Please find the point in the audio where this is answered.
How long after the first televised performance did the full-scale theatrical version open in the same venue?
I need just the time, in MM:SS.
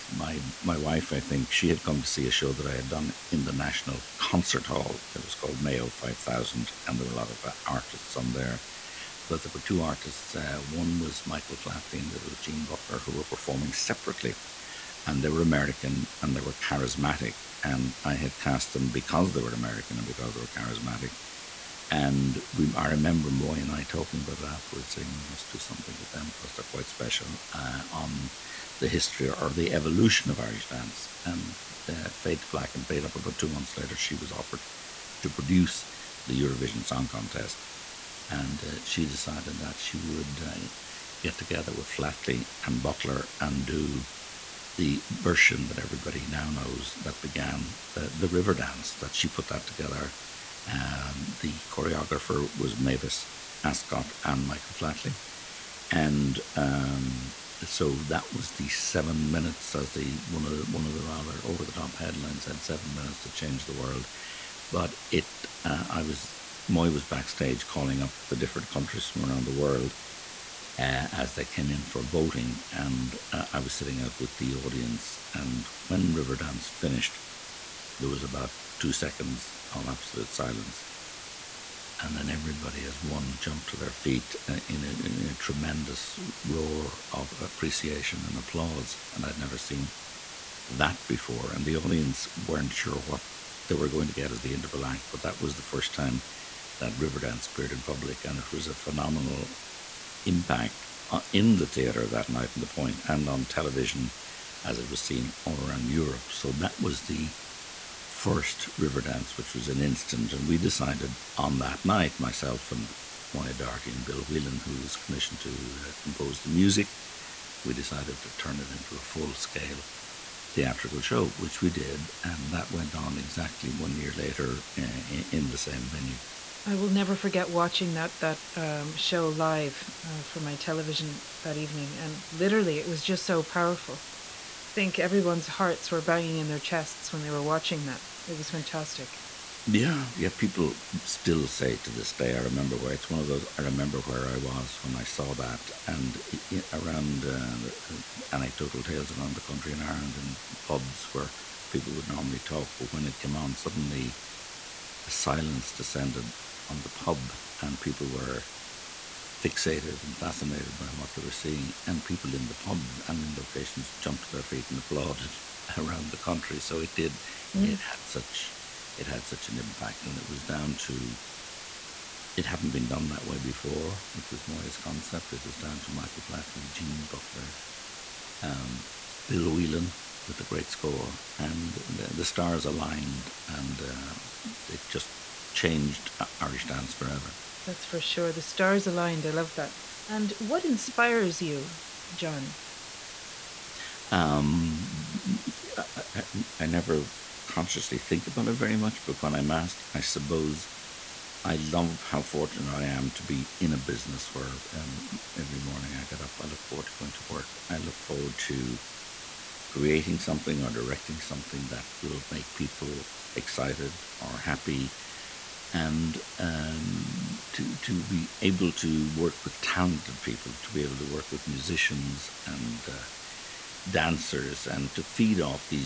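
02:03.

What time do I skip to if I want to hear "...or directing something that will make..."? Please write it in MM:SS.
03:30.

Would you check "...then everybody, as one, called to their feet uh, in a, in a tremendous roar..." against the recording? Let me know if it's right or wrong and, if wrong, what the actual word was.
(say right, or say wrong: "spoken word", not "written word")
wrong: "jumped", not "called".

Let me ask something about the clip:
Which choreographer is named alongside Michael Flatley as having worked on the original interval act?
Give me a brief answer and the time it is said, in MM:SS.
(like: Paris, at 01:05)
Mavis Ascott, at 00:52.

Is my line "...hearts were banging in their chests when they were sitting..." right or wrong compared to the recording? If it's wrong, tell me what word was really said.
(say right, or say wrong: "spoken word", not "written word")
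wrong: "watching", not "sitting".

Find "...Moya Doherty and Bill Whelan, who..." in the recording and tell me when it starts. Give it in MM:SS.
01:53.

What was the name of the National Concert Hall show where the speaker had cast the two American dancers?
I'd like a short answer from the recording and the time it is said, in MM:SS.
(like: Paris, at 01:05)
Mayo Five Thousand, at 00:05.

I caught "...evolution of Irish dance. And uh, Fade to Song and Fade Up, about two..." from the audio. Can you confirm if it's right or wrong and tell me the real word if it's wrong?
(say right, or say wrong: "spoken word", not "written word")
wrong: "Black", not "Song".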